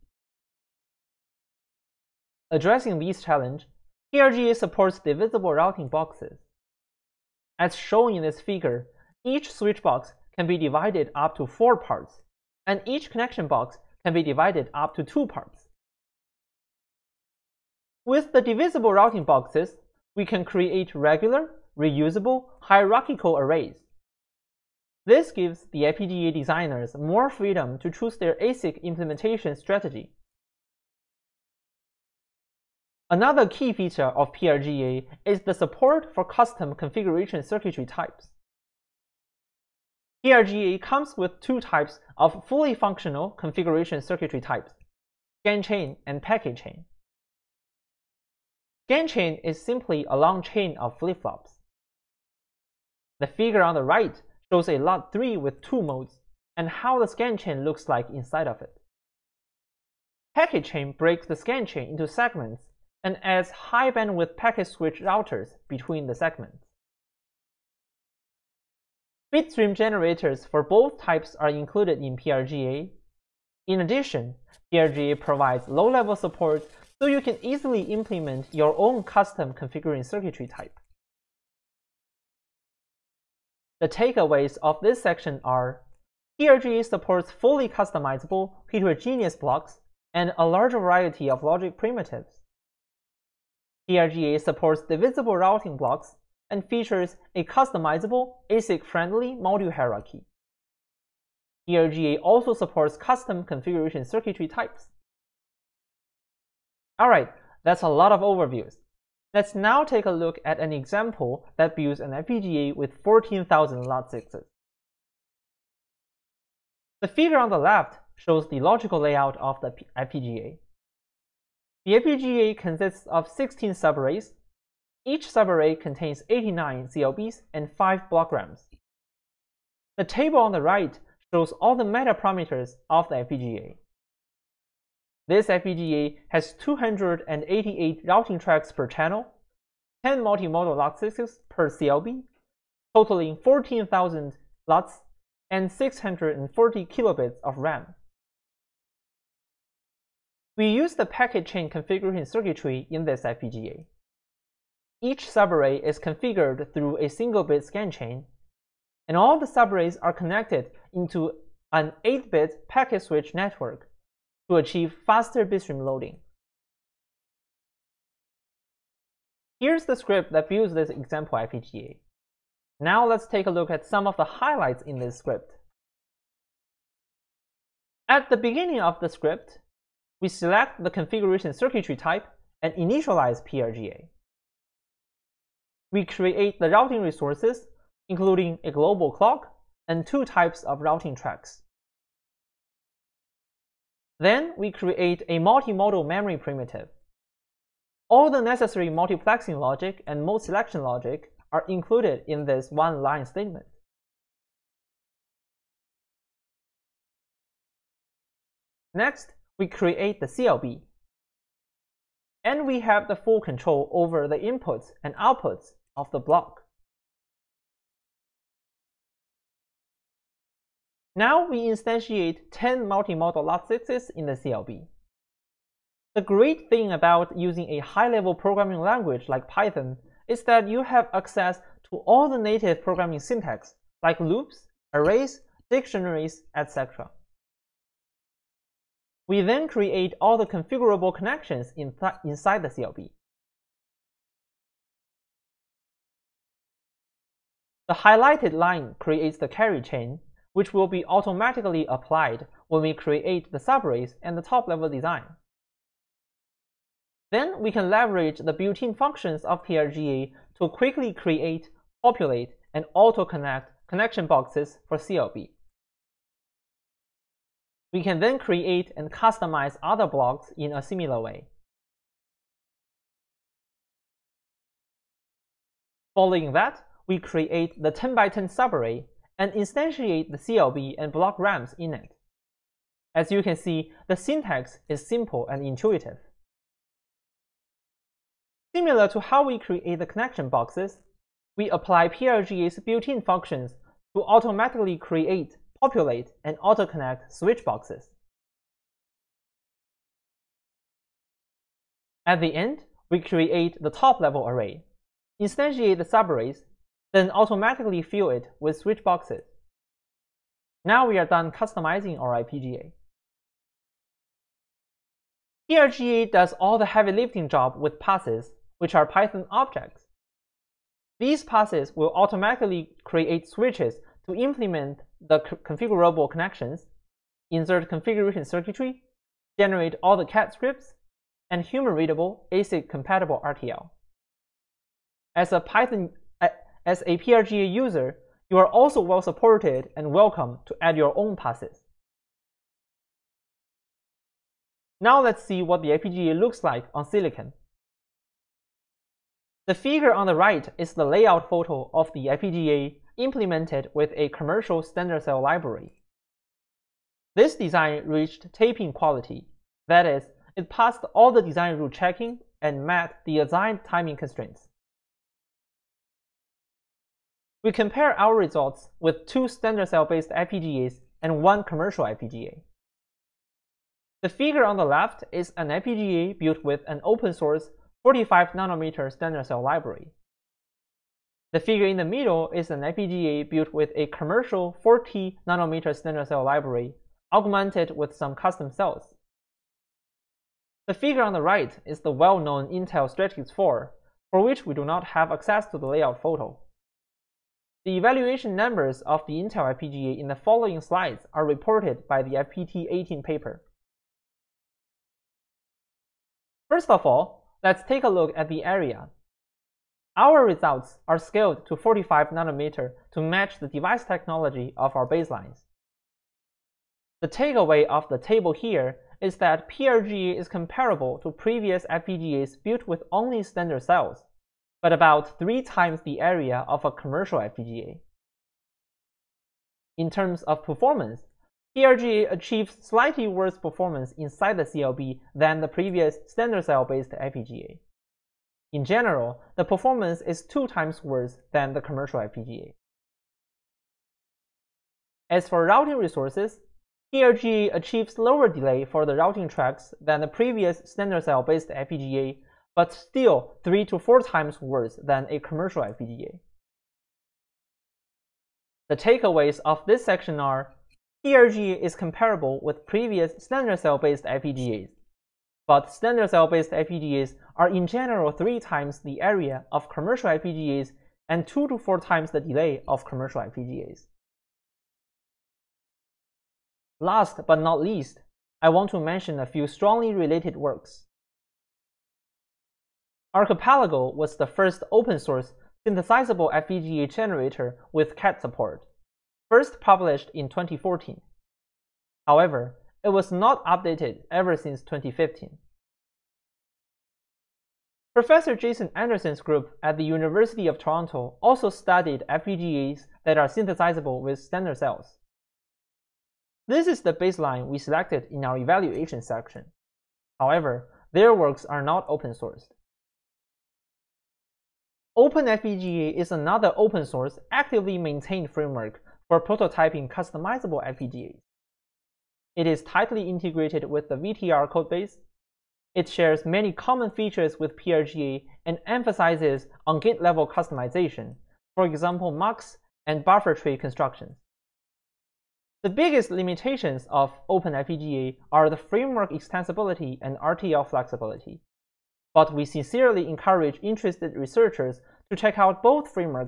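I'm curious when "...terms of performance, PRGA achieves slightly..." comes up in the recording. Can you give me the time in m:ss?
7:10.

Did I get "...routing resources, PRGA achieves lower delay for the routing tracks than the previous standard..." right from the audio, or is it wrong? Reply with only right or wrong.
right.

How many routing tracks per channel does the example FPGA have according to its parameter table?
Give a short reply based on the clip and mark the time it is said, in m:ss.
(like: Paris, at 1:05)
288, at 2:16.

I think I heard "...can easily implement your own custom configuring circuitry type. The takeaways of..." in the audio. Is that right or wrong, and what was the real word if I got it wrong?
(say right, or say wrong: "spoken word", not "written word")
right.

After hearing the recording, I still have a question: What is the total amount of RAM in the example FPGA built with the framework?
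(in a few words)
640 kilobits.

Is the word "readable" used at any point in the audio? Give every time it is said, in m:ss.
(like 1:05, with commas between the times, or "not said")
5:31.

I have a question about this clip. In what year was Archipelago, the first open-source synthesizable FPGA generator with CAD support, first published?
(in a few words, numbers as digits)
2014.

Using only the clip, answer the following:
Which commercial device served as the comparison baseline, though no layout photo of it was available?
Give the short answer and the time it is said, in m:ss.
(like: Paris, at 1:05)
Intel Stratix 4, at 6:32.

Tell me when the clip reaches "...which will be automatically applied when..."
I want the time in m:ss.
4:10.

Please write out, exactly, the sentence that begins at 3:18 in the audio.
All the necessary multiplexing logic and mode selection logic are included in this one-line statement.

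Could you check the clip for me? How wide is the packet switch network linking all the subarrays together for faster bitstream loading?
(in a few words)
8-bit.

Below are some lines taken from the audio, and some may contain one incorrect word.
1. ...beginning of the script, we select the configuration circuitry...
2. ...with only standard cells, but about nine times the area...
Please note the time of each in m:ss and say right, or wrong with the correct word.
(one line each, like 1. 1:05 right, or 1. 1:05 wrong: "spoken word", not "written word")
1. 2:58 right
2. 7:02 wrong: "three", not "nine".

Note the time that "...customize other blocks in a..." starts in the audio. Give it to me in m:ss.
4:29.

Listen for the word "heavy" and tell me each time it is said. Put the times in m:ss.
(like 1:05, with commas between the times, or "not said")
5:16.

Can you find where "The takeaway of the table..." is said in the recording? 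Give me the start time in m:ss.
6:57.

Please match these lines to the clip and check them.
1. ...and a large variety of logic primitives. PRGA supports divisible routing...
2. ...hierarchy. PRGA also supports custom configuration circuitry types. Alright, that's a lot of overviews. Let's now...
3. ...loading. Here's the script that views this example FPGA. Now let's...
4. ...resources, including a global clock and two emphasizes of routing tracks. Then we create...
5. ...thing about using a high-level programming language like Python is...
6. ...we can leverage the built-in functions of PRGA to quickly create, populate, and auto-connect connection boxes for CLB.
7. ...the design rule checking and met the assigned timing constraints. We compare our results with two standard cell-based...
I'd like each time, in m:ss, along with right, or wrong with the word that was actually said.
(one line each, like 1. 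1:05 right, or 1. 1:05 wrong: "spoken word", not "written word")
1. 1:30 right
2. 1:39 right
3. 2:45 right
4. 3:07 wrong: "types", not "emphasizes"
5. 3:46 right
6. 4:17 right
7. 6:01 right.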